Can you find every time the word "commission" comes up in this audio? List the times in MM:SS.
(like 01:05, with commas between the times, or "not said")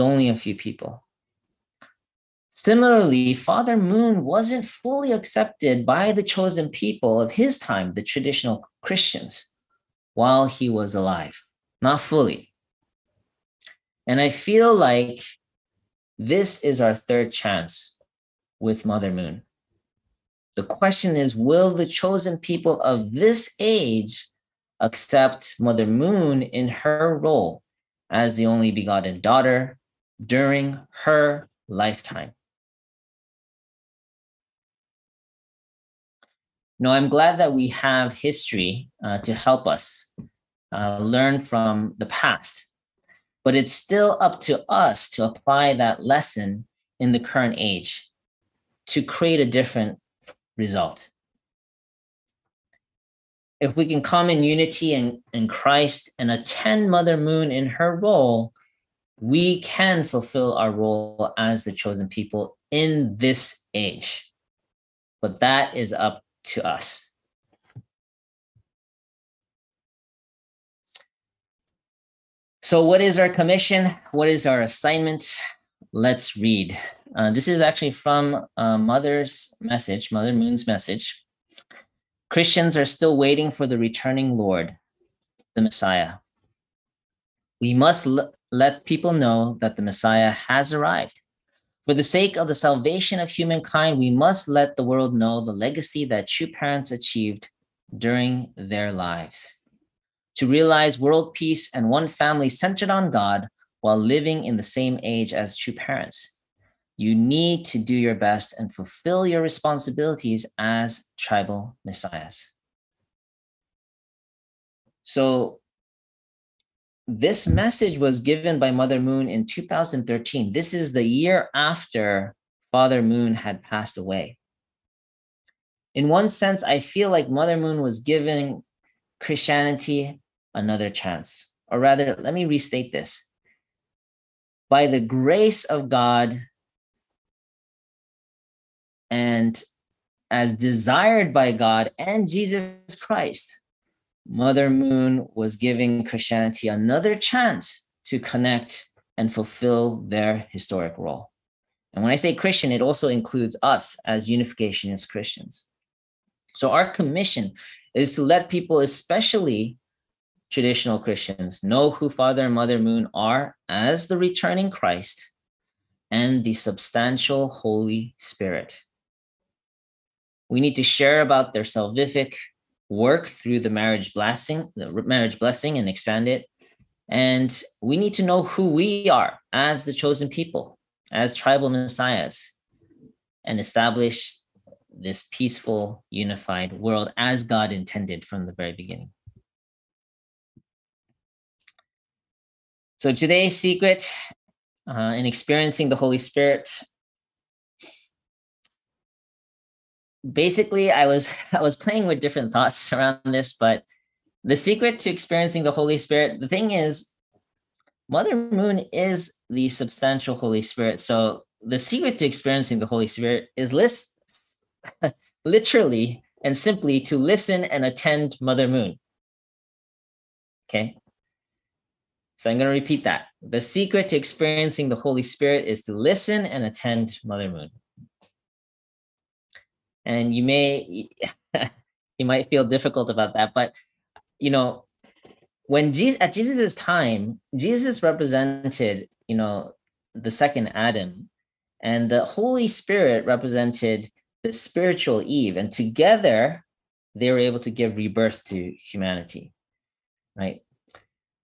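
01:13, 02:36.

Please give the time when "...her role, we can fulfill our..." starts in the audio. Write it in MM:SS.
00:57.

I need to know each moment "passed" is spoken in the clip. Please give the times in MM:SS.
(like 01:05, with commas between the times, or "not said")
02:03.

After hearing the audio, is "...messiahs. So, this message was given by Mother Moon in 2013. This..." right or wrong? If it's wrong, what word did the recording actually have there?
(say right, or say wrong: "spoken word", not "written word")
right.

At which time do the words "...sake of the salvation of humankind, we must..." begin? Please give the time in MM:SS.
01:32.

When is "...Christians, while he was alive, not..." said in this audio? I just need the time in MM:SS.
00:08.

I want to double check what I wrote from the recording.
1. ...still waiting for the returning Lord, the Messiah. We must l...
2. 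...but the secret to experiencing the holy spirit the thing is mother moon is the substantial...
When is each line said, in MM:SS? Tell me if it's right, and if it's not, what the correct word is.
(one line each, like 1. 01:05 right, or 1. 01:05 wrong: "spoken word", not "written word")
1. 01:22 right
2. 03:23 right.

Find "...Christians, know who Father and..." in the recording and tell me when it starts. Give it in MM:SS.
02:40.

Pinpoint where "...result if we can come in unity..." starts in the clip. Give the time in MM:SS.
00:50.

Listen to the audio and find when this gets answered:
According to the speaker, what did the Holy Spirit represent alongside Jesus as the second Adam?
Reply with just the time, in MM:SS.
04:04.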